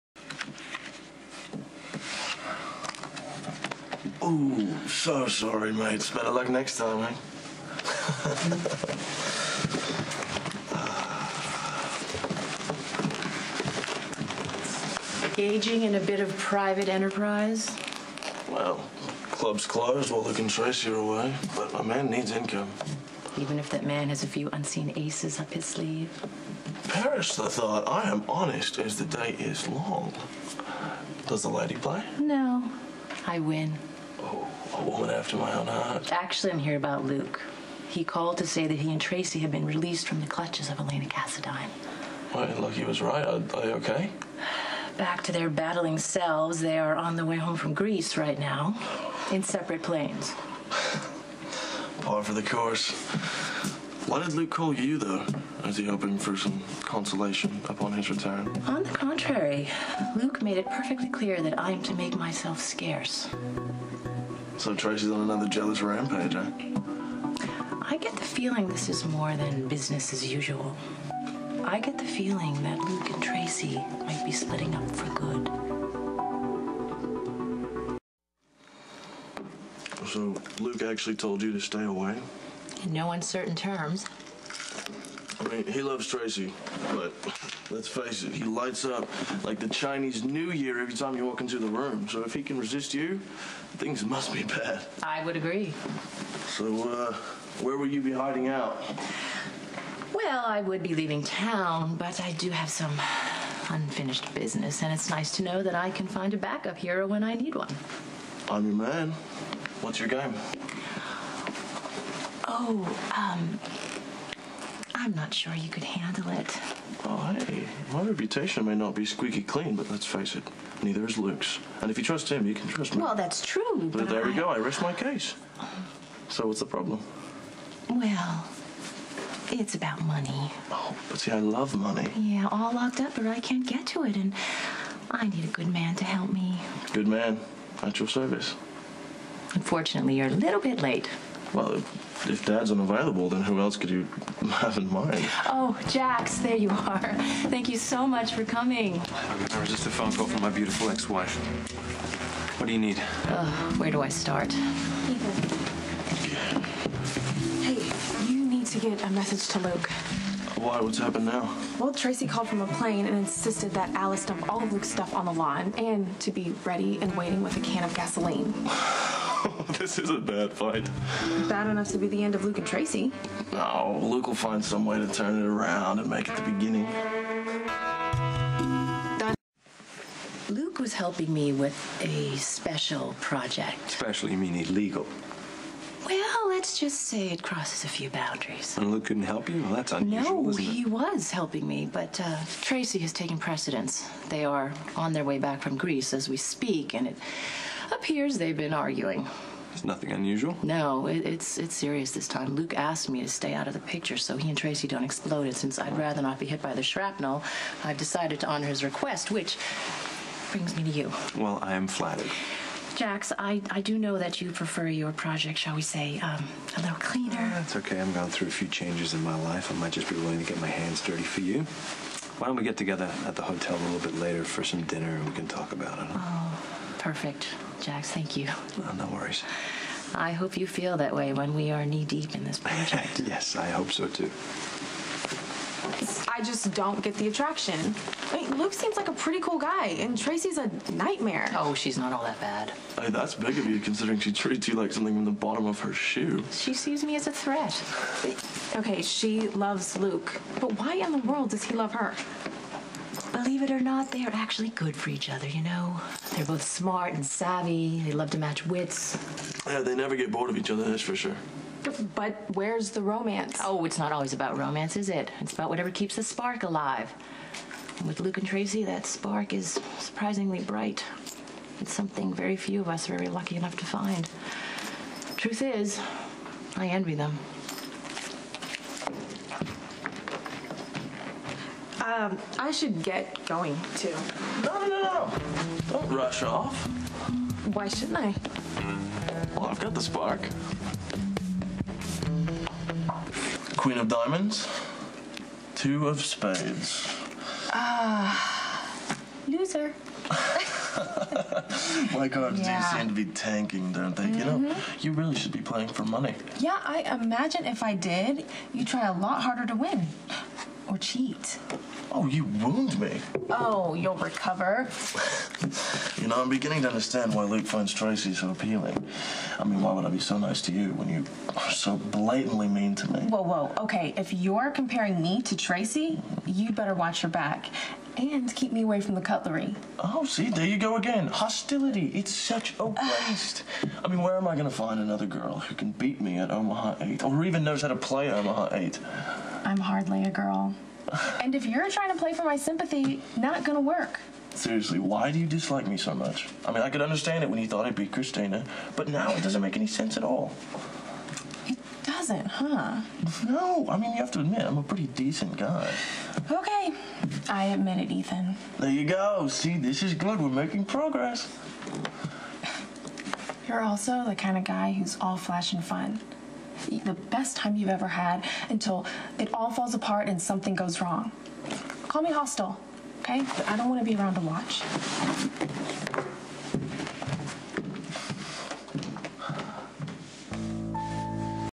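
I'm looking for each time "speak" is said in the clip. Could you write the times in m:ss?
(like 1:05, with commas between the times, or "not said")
3:16.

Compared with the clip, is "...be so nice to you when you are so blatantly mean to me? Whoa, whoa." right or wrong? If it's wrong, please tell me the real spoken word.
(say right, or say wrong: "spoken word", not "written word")
right.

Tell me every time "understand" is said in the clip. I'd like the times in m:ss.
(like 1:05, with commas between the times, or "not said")
5:16, 5:47.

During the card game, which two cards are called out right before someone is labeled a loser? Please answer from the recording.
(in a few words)
Queen of Diamonds, Two of Spades.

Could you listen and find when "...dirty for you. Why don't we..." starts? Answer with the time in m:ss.
3:41.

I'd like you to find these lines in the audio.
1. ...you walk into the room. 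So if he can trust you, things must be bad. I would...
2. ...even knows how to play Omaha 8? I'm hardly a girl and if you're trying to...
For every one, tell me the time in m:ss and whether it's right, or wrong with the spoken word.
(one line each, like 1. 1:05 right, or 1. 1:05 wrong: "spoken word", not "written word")
1. 1:31 wrong: "resist", not "trust"
2. 5:37 right.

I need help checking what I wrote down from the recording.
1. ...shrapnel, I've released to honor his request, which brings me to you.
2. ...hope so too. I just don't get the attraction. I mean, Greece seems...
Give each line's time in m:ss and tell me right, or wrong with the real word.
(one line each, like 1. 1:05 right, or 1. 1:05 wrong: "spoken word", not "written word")
1. 3:26 wrong: "decided", not "released"
2. 3:53 wrong: "Luke", not "Greece".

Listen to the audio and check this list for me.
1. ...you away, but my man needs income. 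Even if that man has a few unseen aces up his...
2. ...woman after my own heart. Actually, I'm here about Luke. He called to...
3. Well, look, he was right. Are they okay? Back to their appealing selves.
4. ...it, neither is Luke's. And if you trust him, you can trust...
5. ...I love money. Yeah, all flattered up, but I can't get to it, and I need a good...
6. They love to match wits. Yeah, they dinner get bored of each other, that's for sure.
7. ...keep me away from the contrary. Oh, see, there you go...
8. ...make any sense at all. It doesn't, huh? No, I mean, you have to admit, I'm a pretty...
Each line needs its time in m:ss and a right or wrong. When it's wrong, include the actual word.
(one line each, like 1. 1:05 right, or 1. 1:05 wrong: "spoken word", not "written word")
1. 0:20 right
2. 0:34 right
3. 0:42 wrong: "battling", not "appealing"
4. 2:00 right
5. 2:11 wrong: "locked", not "flattered"
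6. 4:18 wrong: "never", not "dinner"
7. 5:28 wrong: "cutlery", not "contrary"
8. 5:49 right.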